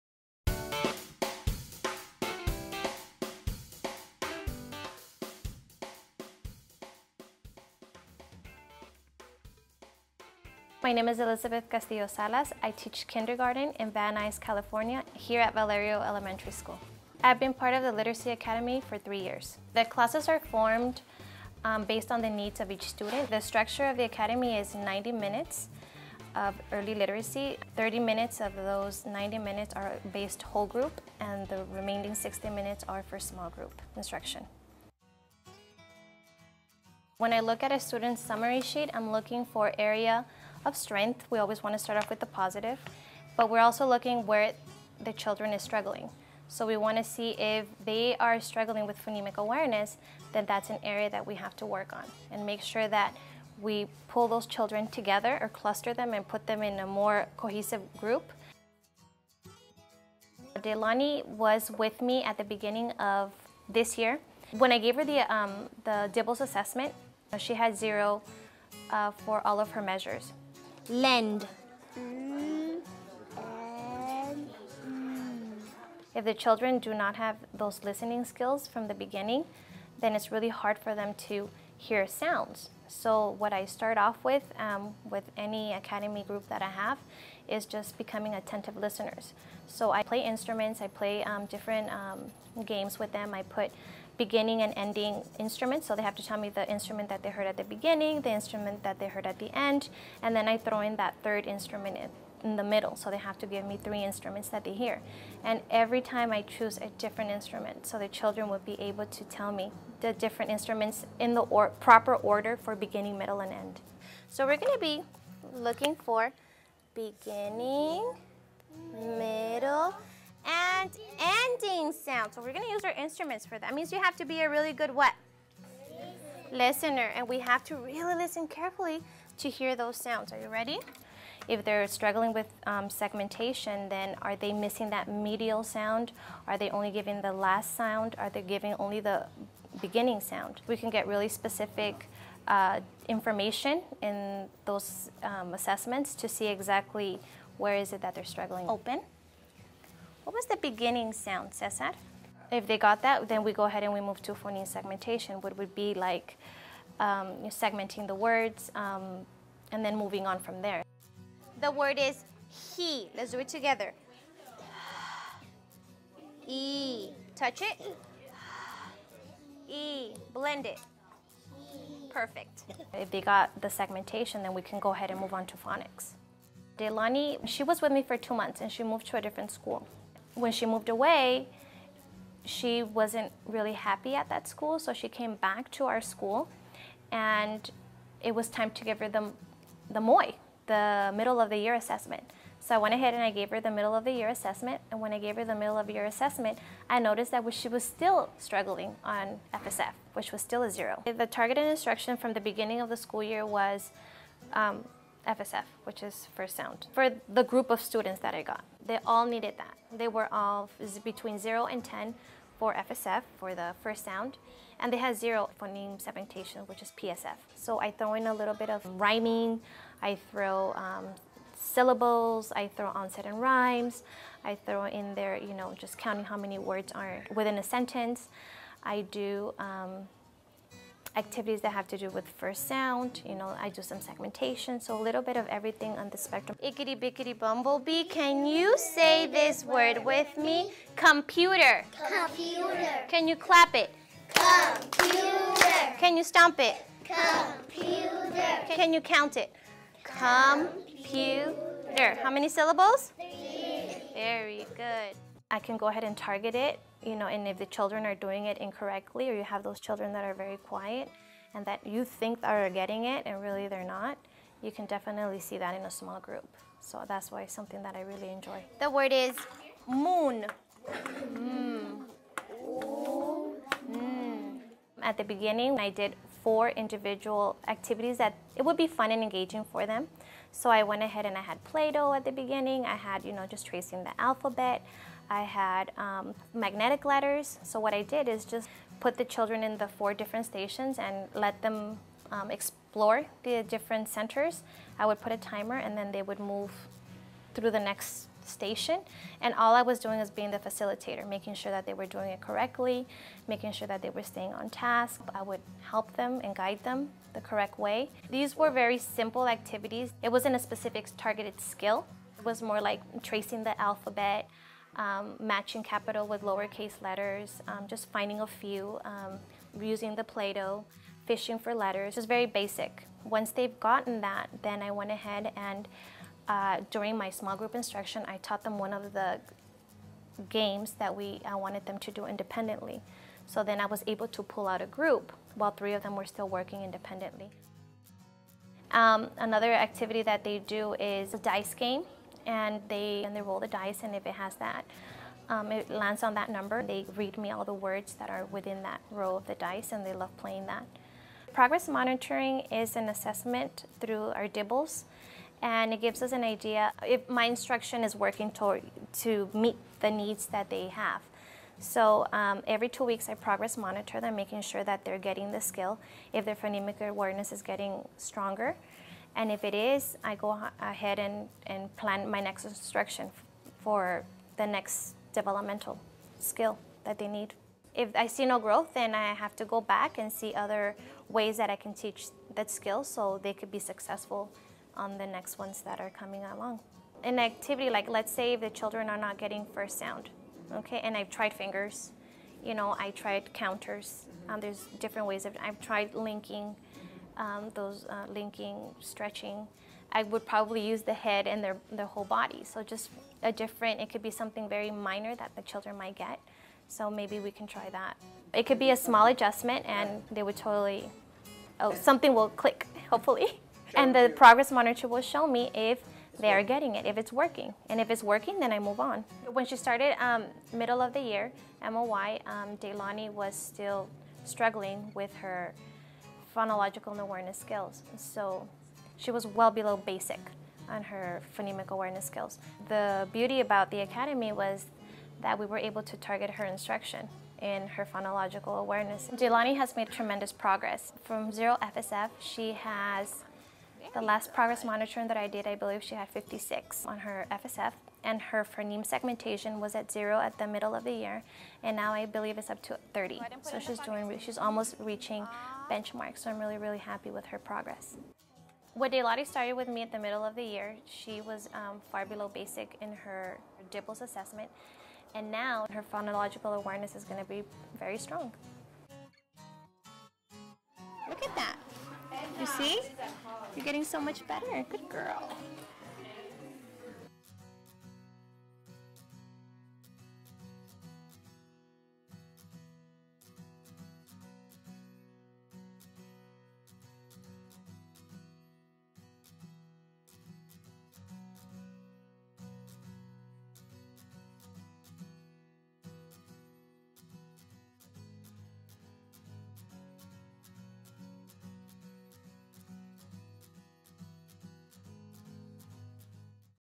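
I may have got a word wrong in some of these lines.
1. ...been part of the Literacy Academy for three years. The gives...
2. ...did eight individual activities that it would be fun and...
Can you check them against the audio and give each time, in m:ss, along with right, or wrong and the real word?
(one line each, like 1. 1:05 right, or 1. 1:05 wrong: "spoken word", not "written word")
1. 0:17 wrong: "classes", not "gives"
2. 4:35 wrong: "four", not "eight".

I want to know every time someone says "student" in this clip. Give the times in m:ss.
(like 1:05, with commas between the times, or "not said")
0:22, 0:37, 3:27.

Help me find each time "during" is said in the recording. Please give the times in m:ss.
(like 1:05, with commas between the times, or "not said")
5:26.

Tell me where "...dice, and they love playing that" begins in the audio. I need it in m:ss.
5:49.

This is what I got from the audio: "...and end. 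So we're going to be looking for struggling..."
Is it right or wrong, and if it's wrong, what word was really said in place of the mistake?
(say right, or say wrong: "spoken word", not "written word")
wrong: "beginning", not "struggling".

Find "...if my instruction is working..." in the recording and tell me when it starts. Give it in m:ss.
5:57.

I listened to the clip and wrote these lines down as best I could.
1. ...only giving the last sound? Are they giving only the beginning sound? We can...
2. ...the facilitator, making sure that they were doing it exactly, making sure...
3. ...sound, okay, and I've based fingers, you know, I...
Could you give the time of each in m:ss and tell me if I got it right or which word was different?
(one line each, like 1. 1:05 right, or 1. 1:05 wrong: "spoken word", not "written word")
1. 2:16 right
2. 5:00 wrong: "correctly", not "exactly"
3. 6:29 wrong: "tried", not "based".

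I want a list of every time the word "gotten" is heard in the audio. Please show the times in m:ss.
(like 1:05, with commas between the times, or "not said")
5:23.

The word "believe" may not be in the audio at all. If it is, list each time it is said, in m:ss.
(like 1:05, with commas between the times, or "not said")
7:25, 7:32.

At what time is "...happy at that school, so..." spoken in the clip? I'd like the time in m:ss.
3:03.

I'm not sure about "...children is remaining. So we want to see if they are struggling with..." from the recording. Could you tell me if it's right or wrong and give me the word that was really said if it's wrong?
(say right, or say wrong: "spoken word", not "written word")
wrong: "struggling", not "remaining".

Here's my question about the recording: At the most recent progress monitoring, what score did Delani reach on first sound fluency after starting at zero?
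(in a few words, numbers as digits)
56.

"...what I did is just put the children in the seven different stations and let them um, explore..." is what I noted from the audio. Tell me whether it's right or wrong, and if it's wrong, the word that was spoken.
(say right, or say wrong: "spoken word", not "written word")
wrong: "four", not "seven".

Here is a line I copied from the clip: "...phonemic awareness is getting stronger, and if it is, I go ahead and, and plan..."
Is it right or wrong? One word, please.
right.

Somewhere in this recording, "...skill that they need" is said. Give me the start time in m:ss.
6:16.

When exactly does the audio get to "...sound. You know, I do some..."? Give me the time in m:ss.
3:52.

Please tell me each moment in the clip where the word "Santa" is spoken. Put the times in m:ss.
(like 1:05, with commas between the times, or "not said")
not said.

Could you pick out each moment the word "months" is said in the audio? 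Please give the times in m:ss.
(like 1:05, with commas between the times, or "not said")
2:58.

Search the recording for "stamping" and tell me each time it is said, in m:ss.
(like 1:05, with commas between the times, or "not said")
not said.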